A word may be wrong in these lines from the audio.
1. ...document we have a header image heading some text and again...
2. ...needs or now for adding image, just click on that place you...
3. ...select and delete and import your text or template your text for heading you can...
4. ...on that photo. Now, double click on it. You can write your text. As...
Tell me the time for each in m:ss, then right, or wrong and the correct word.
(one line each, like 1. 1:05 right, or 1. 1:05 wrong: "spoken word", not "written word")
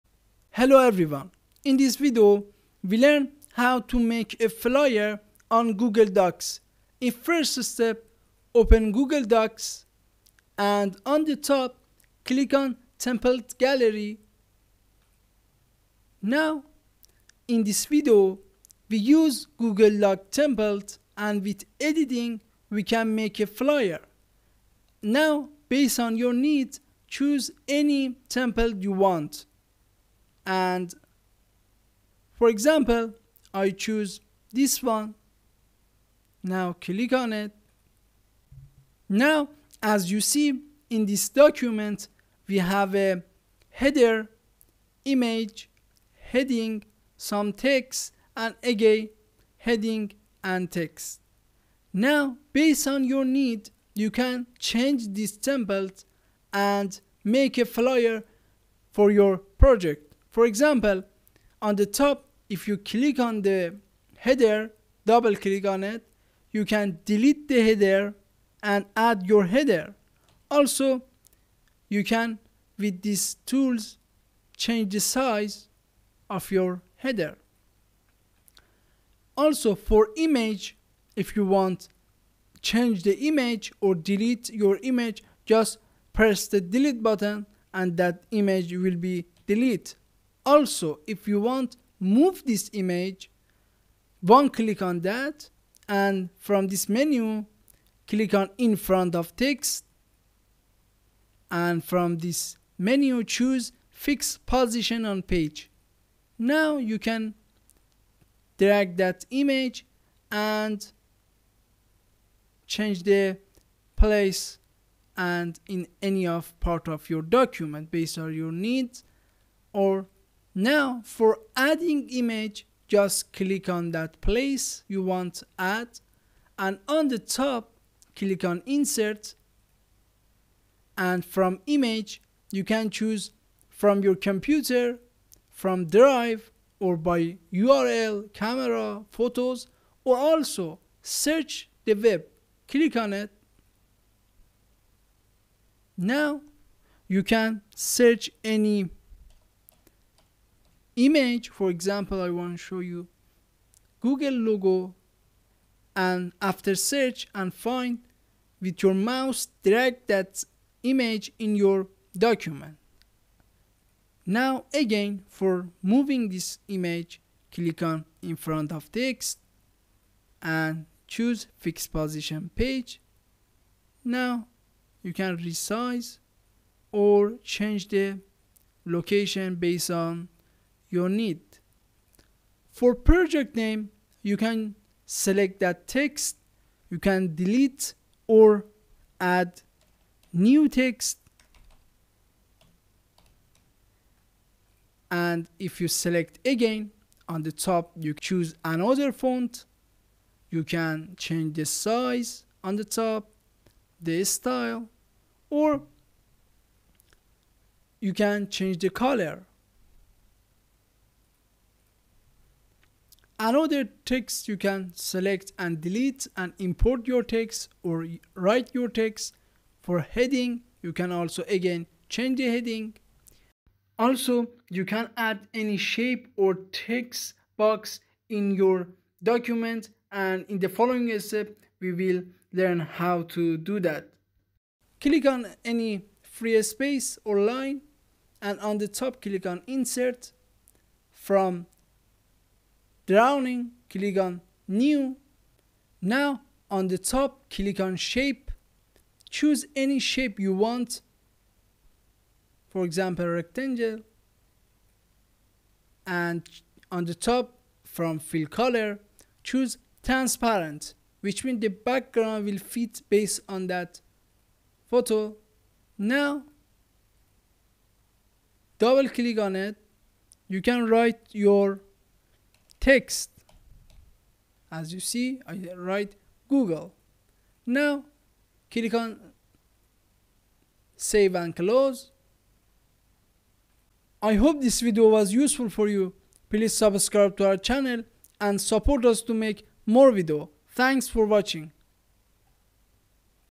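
1. 0:41 right
2. 1:58 right
3. 3:34 wrong: "write", not "template"
4. 4:23 right.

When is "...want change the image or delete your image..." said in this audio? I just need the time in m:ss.
1:21.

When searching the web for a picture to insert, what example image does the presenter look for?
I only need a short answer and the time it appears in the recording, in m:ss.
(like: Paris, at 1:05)
Google logo, at 2:33.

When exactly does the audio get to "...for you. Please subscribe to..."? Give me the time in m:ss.
4:45.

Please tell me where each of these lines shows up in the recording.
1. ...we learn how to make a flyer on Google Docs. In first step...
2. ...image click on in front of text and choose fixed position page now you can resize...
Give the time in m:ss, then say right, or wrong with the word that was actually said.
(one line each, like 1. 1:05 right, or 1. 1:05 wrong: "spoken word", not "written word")
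1. 0:02 right
2. 2:46 right.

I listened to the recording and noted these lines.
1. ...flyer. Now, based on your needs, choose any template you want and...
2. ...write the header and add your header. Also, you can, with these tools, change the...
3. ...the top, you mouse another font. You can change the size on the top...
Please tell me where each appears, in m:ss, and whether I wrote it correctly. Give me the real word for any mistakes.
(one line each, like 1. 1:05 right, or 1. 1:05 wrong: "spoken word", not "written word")
1. 0:23 right
2. 1:07 wrong: "delete", not "write"
3. 3:17 wrong: "choose", not "mouse".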